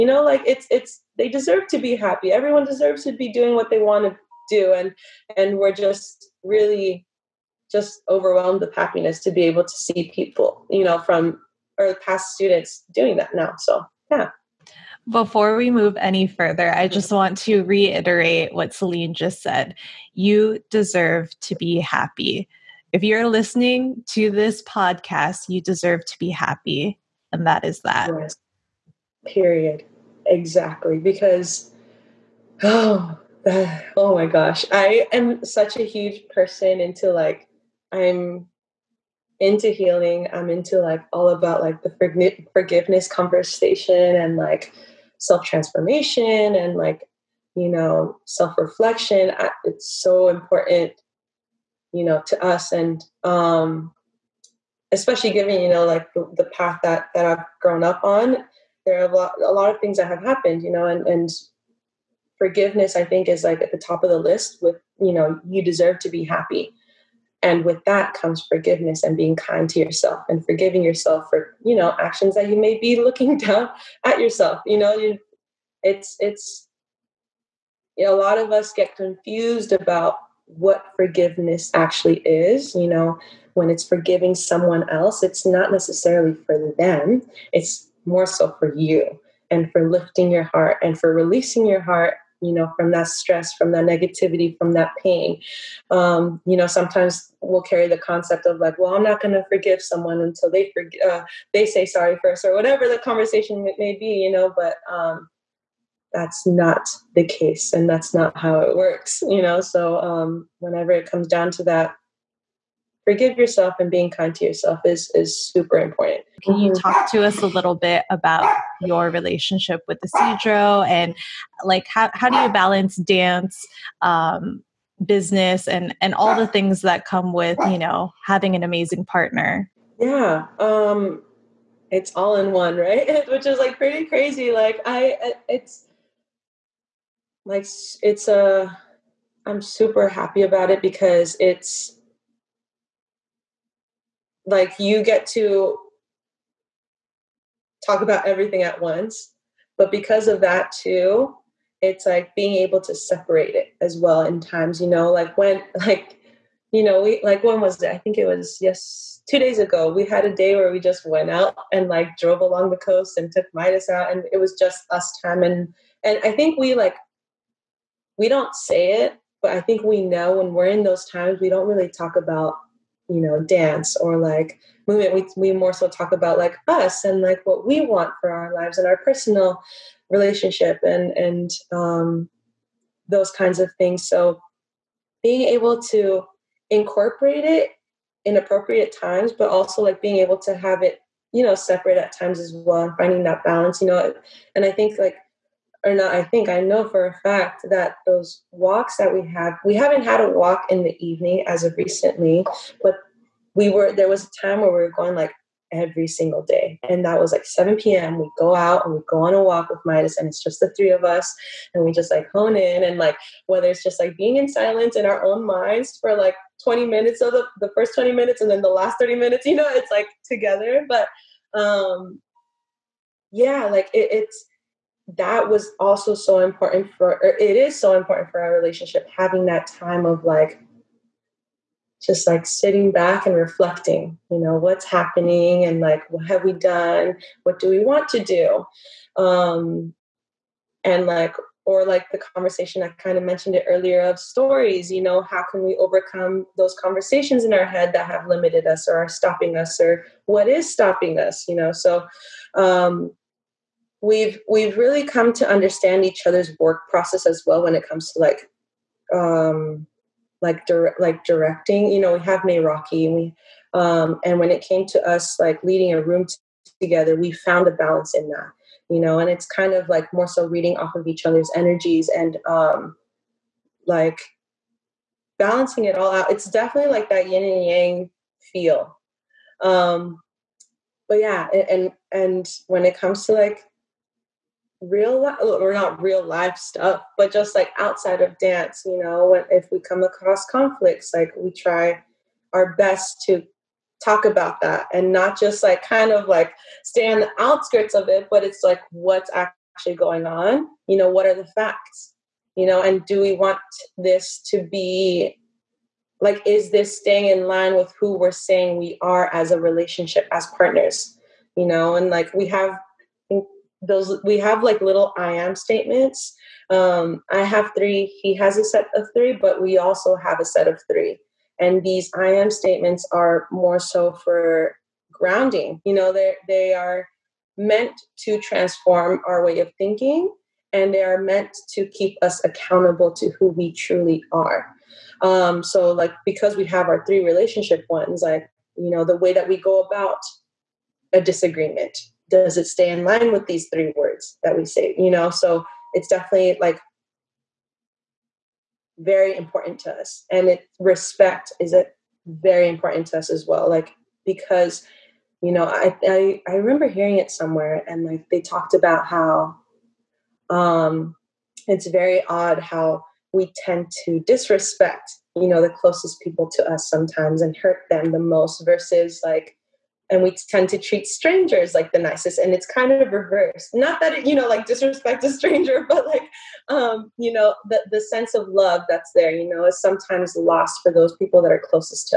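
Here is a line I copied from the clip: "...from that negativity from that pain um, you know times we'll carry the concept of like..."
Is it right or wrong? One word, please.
wrong.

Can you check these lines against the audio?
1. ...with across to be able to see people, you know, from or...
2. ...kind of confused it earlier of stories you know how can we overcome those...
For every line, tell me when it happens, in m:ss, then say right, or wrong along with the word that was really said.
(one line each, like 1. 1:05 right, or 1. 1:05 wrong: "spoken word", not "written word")
1. 0:08 wrong: "happiness", not "across"
2. 4:02 wrong: "mentioned", not "confused".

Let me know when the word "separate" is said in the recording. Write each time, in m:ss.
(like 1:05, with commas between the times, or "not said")
2:32, 3:11.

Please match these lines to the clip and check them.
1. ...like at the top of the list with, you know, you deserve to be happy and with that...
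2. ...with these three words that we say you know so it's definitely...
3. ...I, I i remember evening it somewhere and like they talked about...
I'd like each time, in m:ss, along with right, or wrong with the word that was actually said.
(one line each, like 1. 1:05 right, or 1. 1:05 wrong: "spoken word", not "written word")
1. 1:03 right
2. 5:43 right
3. 5:55 wrong: "hearing", not "evening".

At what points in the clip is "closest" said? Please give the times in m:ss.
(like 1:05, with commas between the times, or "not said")
6:05, 6:21.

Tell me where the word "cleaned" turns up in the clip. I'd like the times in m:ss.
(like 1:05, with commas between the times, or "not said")
not said.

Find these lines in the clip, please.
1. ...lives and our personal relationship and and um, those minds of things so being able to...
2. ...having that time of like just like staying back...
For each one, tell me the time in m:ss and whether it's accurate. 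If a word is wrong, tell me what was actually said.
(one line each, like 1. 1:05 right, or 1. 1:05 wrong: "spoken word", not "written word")
1. 2:58 wrong: "kinds", not "minds"
2. 3:49 wrong: "sitting", not "staying".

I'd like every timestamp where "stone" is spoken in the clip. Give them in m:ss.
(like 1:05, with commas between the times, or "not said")
not said.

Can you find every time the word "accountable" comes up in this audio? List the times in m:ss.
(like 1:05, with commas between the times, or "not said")
5:32.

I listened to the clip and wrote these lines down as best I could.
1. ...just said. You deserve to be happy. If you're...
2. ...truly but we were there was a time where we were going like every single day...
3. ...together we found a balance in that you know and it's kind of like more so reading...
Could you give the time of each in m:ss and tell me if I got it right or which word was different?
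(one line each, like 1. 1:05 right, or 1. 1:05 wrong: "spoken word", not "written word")
1. 0:19 right
2. 3:21 wrong: "recently", not "truly"
3. 4:26 right.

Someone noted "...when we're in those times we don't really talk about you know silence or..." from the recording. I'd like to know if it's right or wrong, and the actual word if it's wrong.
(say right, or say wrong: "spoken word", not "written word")
wrong: "dance", not "silence".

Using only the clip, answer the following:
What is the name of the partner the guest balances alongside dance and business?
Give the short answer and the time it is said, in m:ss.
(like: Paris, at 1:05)
Isidro, at 2:00.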